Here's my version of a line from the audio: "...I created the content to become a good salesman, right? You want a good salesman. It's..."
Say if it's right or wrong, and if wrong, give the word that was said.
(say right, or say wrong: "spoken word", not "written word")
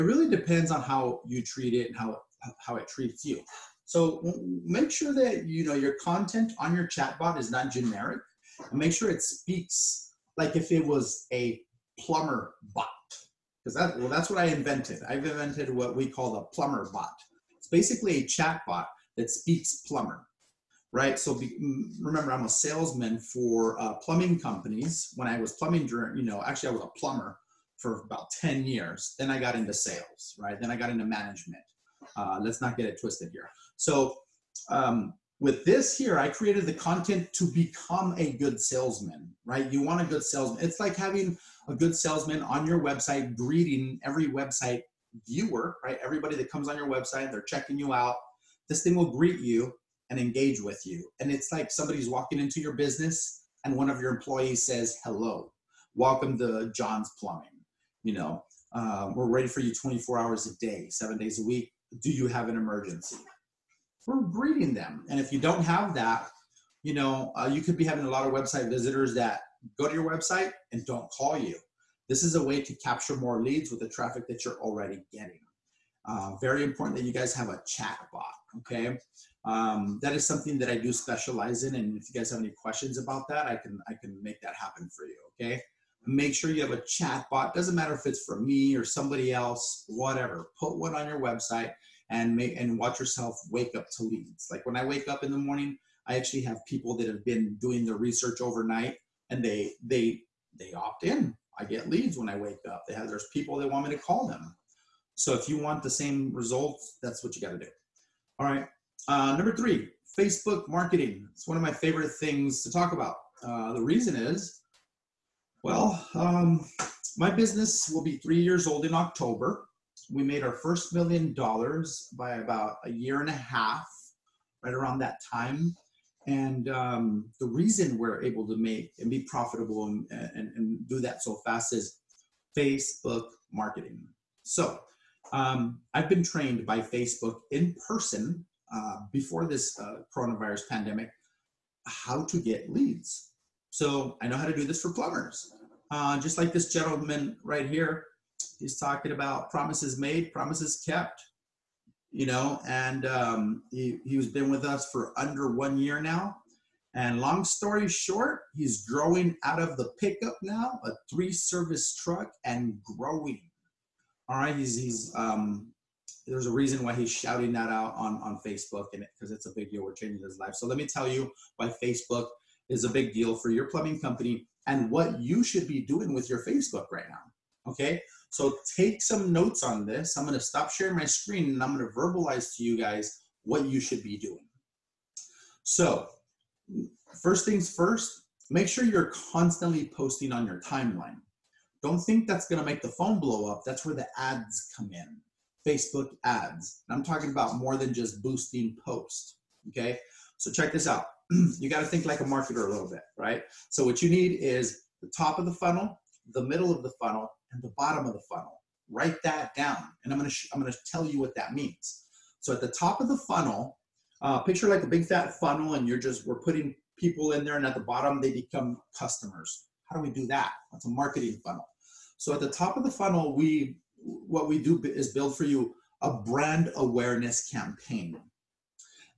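right.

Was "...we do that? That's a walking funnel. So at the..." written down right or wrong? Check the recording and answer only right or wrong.
wrong.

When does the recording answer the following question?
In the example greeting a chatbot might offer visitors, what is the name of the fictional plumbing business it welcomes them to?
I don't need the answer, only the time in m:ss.
0:56.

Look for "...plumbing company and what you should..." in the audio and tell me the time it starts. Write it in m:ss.
2:53.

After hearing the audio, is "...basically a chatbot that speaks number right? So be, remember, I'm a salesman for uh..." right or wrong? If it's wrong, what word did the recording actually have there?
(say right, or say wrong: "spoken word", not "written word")
wrong: "plumber", not "number".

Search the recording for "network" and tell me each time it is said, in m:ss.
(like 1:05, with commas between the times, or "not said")
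not said.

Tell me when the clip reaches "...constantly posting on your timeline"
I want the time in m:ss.
3:09.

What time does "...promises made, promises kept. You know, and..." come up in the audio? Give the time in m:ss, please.
2:29.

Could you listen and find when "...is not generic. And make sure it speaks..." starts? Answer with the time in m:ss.
0:07.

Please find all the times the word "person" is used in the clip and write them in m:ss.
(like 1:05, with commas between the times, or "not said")
2:17.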